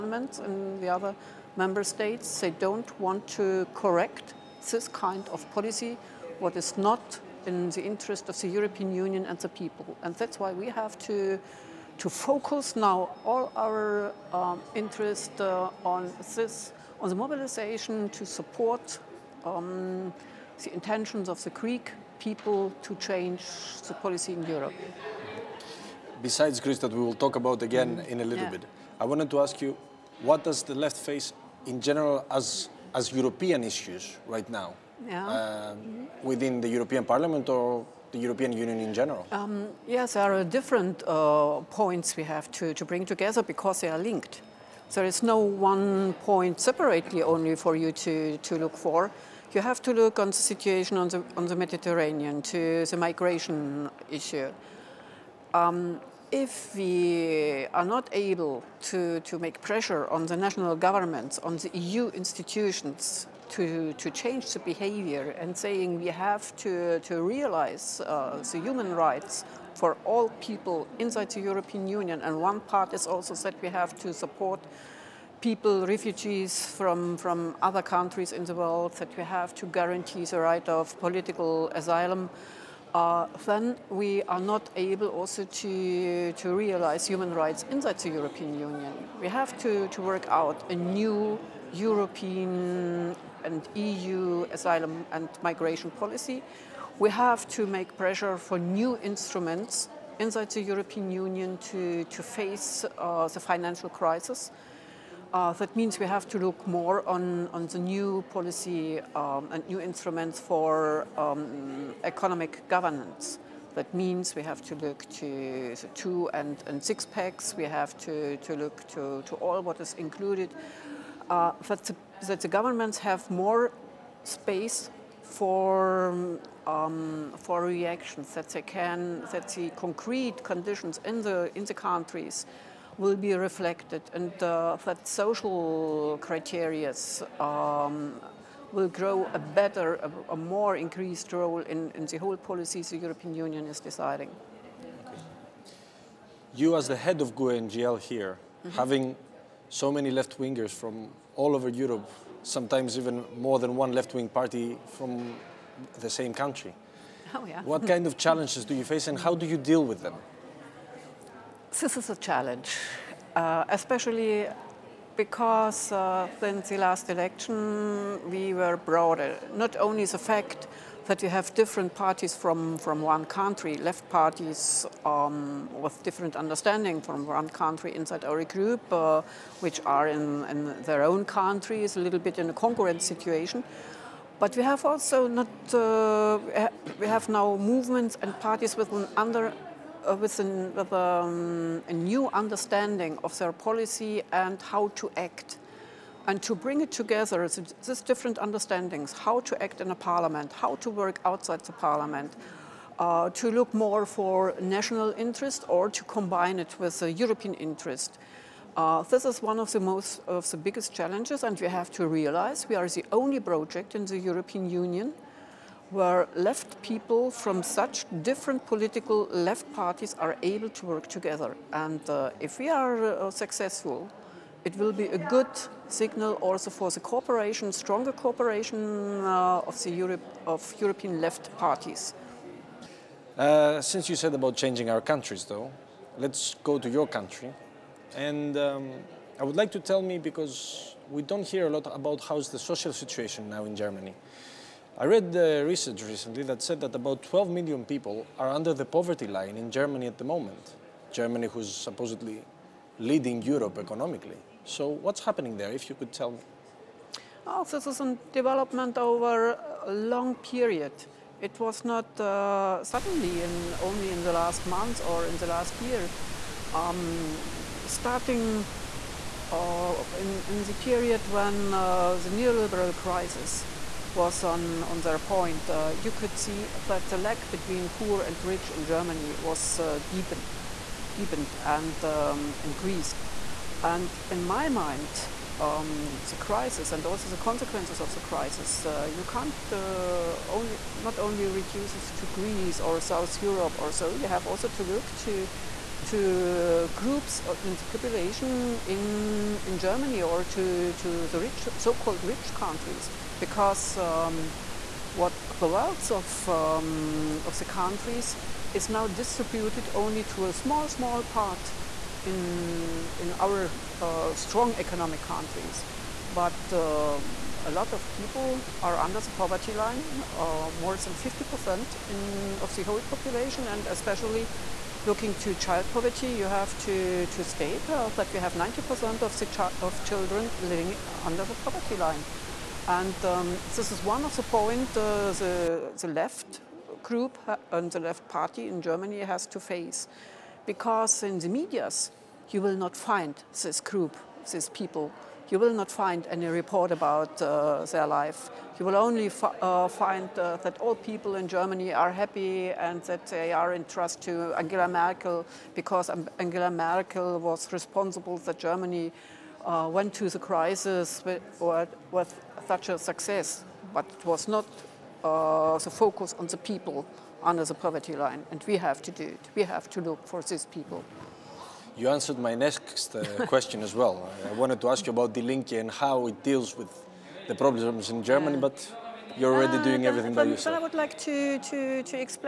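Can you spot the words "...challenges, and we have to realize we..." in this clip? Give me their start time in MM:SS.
03:30.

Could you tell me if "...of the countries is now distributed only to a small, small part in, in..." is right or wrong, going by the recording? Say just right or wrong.
right.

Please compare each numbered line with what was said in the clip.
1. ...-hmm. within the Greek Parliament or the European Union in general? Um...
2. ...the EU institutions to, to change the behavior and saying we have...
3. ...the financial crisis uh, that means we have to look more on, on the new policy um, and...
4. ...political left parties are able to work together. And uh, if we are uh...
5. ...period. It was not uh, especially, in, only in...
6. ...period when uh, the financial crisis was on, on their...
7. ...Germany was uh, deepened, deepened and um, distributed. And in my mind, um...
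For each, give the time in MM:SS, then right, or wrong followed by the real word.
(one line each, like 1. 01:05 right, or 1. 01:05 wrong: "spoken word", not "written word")
1. 00:35 wrong: "European", not "Greek"
2. 01:01 right
3. 01:43 right
4. 03:38 right
5. 04:20 wrong: "suddenly", not "especially"
6. 04:30 wrong: "neoliberal", not "financial"
7. 04:38 wrong: "increased", not "distributed".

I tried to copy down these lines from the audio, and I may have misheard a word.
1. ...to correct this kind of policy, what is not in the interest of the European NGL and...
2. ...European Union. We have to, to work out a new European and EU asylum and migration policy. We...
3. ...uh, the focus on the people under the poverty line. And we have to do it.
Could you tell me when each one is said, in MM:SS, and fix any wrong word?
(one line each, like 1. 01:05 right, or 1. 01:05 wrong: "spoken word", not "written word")
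1. 00:03 wrong: "Union", not "NGL"
2. 01:28 right
3. 06:05 right.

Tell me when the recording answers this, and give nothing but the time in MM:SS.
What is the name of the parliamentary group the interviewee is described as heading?
02:27.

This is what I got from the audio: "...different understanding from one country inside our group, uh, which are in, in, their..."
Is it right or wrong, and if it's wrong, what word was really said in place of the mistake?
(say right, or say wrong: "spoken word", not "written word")
right.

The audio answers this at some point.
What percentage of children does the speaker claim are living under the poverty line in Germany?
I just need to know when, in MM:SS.
05:28.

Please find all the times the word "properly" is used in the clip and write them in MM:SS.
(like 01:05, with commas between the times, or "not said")
not said.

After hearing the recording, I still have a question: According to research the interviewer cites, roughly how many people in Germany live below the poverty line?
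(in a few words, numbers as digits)
12 million.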